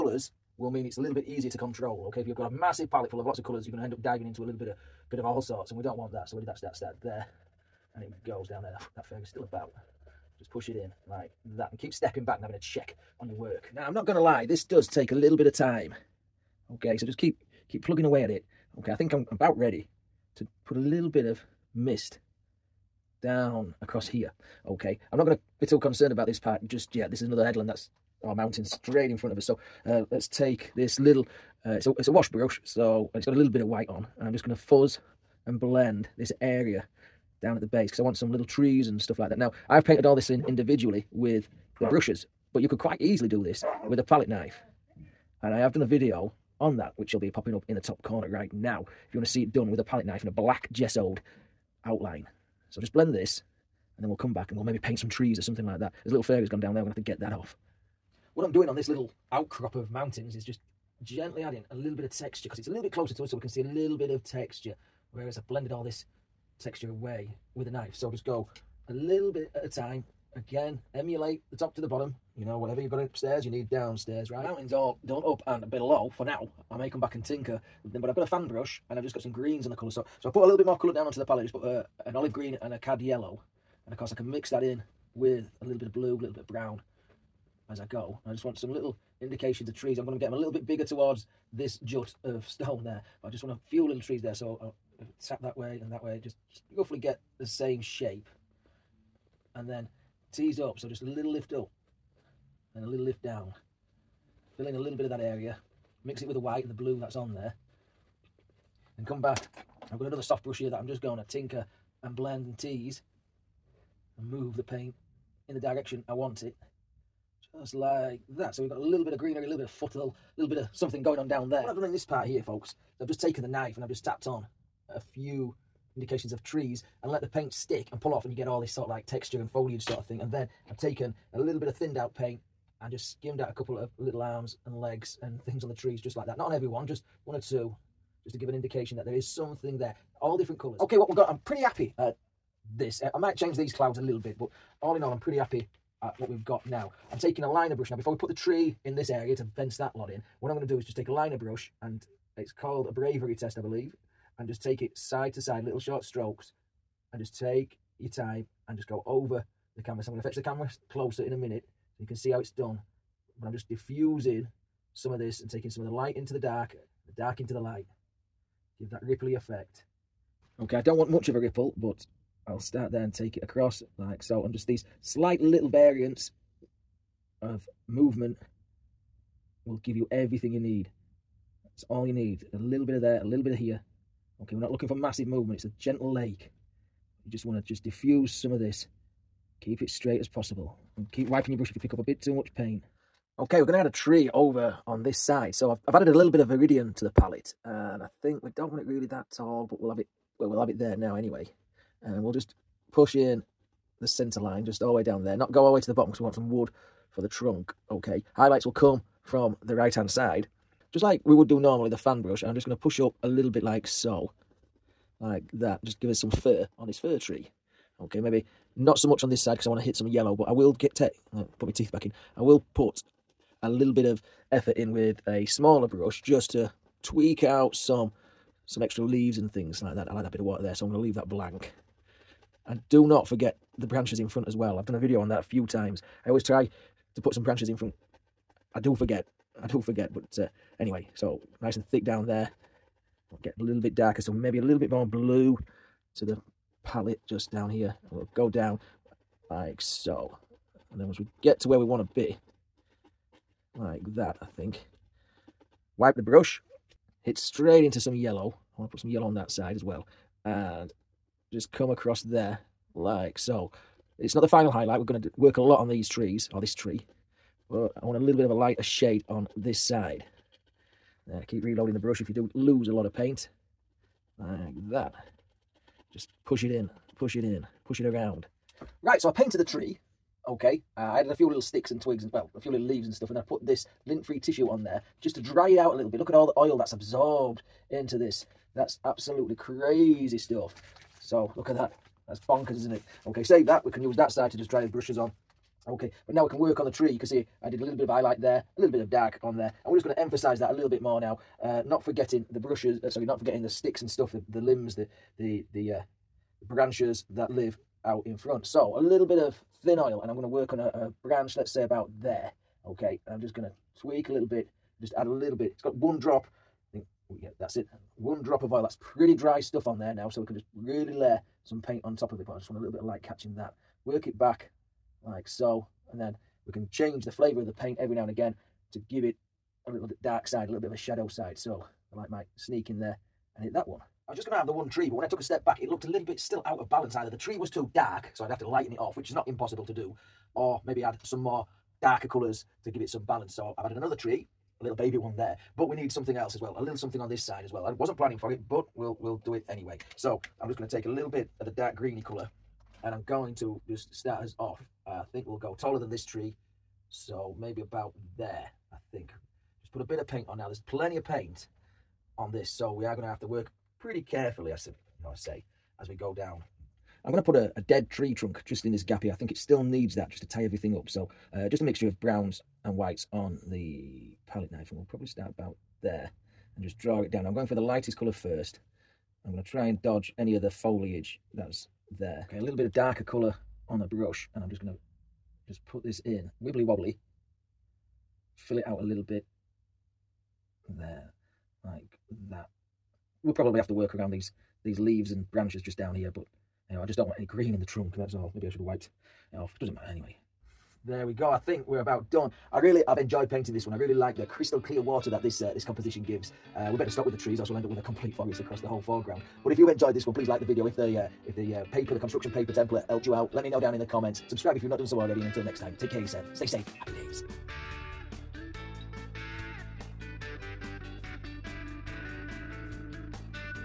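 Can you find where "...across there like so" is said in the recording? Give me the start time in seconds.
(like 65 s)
261 s.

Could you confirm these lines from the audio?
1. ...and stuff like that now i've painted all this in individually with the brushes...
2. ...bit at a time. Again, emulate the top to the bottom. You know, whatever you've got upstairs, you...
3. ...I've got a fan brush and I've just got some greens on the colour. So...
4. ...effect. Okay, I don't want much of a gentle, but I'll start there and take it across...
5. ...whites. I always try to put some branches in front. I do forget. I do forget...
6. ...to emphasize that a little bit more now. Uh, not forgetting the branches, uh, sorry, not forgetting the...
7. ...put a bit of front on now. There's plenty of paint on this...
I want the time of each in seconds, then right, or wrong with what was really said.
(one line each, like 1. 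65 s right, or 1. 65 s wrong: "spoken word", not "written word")
1. 38 s right
2. 69 s right
3. 78 s right
4. 169 s wrong: "ripple", not "gentle"
5. 235 s wrong: "times", not "whites"
6. 300 s wrong: "brushes", not "branches"
7. 359 s wrong: "paint", not "front".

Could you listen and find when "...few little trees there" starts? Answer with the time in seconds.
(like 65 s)
93 s.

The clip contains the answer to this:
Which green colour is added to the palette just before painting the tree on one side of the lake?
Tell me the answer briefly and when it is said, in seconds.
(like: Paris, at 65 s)
Viridian, at 196 s.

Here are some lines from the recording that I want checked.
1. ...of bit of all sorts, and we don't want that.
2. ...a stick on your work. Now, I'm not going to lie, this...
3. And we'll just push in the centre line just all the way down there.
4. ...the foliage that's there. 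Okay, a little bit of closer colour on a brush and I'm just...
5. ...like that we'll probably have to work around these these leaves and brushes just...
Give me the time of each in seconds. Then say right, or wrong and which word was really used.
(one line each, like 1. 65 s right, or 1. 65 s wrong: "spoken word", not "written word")
1. 4 s right
2. 12 s wrong: "check", not "stick"
3. 202 s right
4. 380 s wrong: "darker", not "closer"
5. 391 s wrong: "branches", not "brushes".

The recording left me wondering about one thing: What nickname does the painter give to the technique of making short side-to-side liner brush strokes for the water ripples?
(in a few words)
Bravery test.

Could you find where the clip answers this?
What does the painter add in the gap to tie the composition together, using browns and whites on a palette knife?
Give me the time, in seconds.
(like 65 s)
367 s.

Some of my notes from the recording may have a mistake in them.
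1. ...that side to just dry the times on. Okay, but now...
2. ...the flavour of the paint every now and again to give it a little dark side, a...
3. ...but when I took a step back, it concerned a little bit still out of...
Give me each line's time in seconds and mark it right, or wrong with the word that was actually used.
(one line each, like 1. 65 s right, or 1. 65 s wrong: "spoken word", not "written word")
1. 294 s wrong: "brushes", not "times"
2. 327 s right
3. 335 s wrong: "looked", not "concerned".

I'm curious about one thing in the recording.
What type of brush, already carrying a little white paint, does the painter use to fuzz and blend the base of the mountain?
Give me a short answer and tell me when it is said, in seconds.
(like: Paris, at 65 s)
Wash brush, at 32 s.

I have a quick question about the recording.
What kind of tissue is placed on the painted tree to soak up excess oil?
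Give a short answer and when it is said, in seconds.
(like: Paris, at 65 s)
Lint-free tissue, at 284 s.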